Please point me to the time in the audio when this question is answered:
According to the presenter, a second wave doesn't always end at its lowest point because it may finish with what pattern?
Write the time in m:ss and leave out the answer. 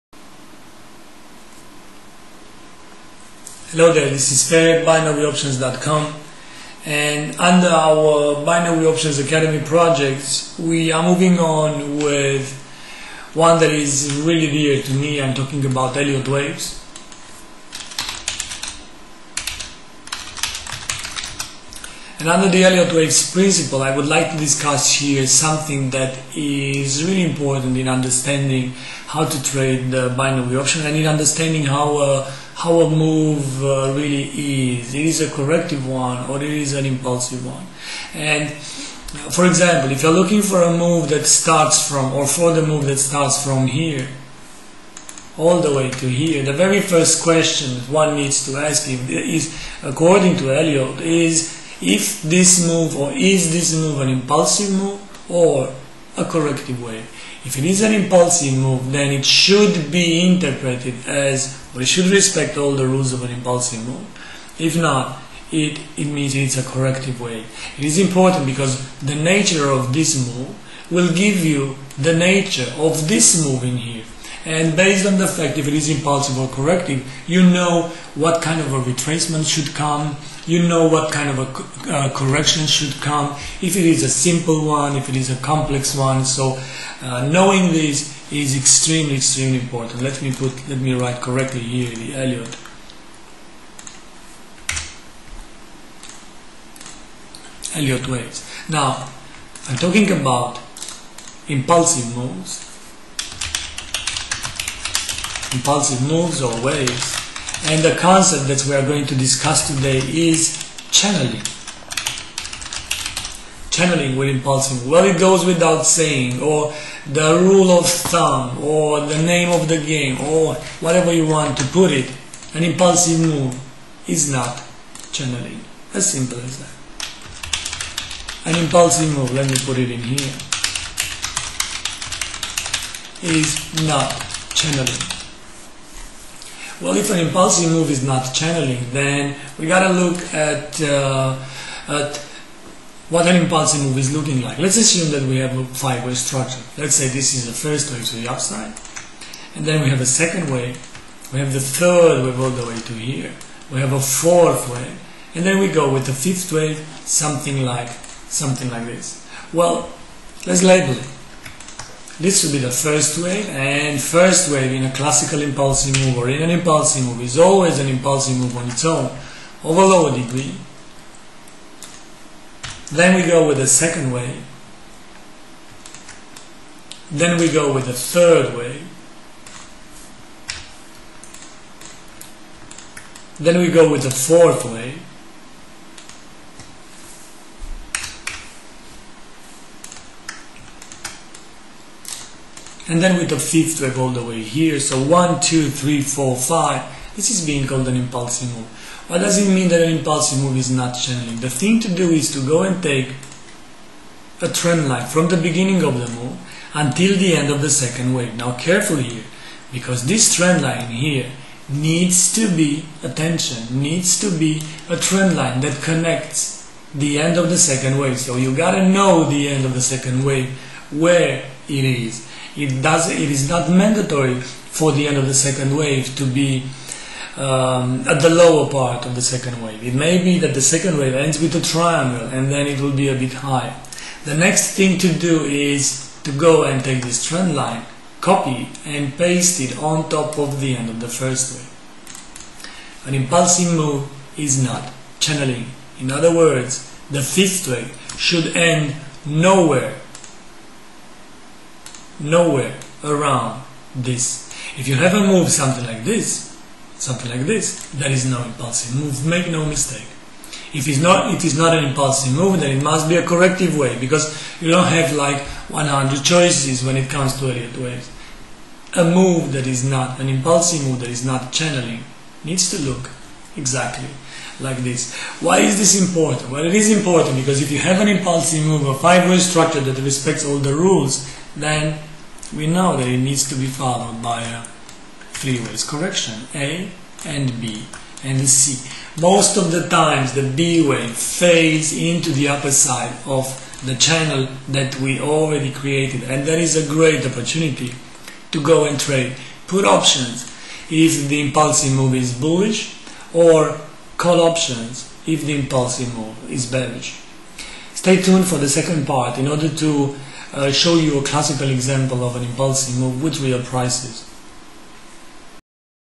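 3:51.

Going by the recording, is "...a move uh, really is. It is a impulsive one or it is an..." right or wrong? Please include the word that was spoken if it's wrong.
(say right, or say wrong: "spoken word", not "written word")
wrong: "corrective", not "impulsive".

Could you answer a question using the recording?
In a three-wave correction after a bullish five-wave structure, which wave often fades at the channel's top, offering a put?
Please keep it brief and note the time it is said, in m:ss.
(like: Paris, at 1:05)
B wave, at 4:50.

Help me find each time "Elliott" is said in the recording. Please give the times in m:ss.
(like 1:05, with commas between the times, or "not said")
0:15, 0:22, 0:50, 1:32, 1:37, 4:27.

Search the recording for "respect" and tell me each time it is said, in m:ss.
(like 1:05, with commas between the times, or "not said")
1:02, 4:40.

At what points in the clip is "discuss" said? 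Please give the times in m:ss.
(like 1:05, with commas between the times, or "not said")
0:24, 1:49.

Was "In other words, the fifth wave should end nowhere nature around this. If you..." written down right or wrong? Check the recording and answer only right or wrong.
wrong.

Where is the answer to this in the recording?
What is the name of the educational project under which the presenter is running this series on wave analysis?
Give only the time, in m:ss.
0:08.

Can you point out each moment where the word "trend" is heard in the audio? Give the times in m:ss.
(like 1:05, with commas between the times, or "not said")
3:24, 3:30, 3:34, 3:57.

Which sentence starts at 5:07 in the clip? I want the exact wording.
Stay tuned for the second part in order to I'll show you a classical example of an impulse move with real prices.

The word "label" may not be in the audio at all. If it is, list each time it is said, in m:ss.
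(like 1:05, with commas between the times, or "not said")
2:40.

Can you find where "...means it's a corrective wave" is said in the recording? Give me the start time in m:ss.
1:06.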